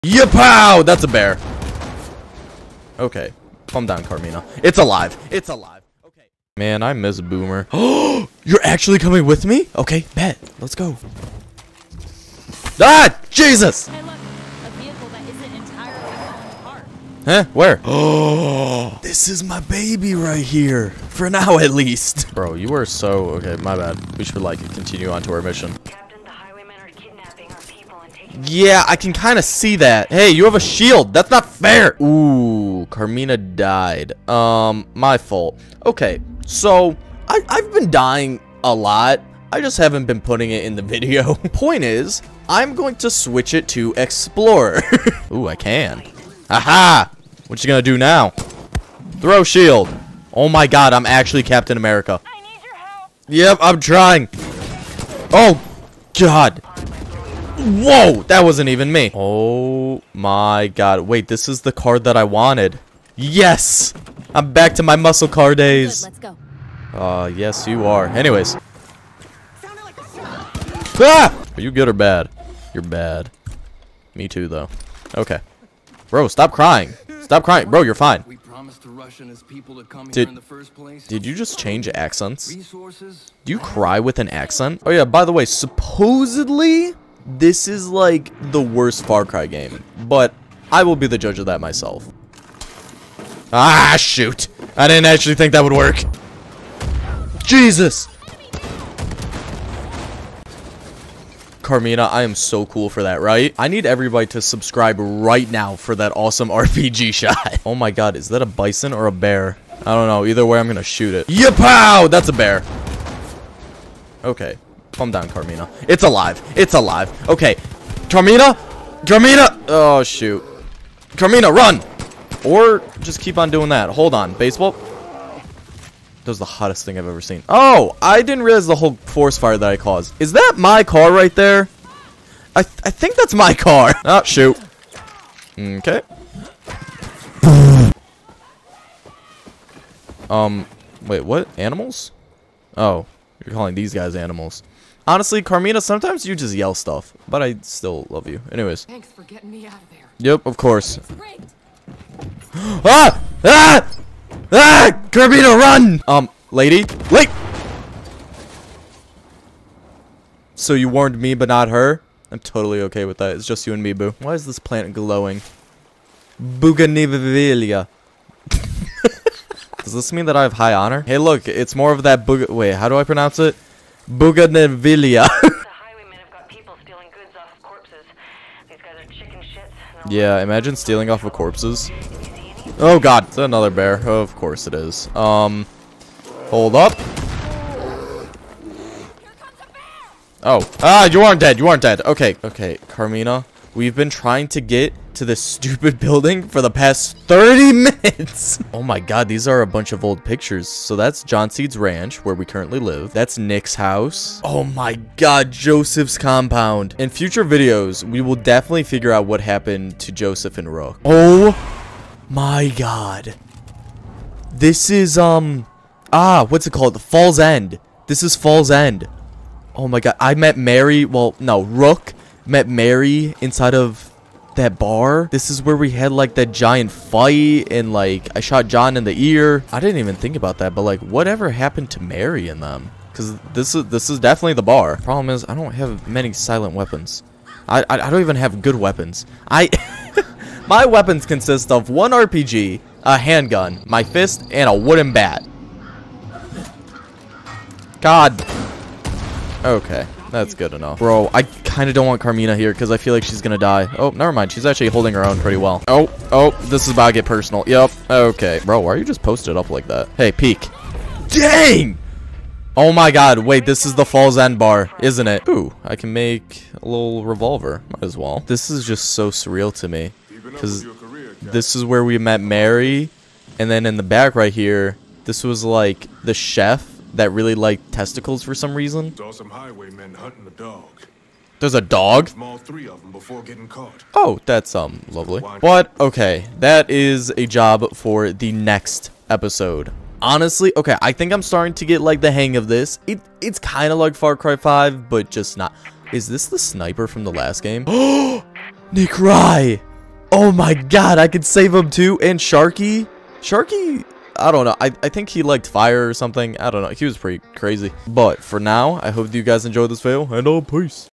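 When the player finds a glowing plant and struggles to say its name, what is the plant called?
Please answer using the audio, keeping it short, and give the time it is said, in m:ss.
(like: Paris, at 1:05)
Bougainvillea, at 2:54.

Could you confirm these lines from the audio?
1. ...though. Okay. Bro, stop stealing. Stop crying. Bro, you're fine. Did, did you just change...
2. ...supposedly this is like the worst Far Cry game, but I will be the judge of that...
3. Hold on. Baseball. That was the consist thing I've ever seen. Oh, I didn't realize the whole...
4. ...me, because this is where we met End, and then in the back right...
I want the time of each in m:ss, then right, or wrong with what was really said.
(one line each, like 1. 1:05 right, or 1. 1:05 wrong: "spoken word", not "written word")
1. 1:14 wrong: "crying", not "stealing"
2. 1:25 right
3. 2:03 wrong: "hottest", not "consist"
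4. 4:29 wrong: "Mary", not "End".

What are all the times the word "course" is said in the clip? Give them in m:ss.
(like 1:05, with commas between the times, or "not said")
2:30, 3:04.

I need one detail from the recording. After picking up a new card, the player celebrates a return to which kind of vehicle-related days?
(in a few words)
muscle car.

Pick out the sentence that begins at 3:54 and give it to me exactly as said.
Problem is I don't have many silent weapons.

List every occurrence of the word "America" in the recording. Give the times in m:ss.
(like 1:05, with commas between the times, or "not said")
0:51.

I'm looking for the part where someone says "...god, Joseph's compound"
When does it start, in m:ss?
3:25.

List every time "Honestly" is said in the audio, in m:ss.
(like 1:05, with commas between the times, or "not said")
2:25, 4:50.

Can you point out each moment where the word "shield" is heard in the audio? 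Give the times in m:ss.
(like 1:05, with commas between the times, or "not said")
0:30, 0:49.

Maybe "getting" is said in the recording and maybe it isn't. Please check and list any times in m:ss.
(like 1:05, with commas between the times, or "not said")
2:29.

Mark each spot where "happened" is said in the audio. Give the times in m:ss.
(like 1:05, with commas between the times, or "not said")
3:29, 3:51.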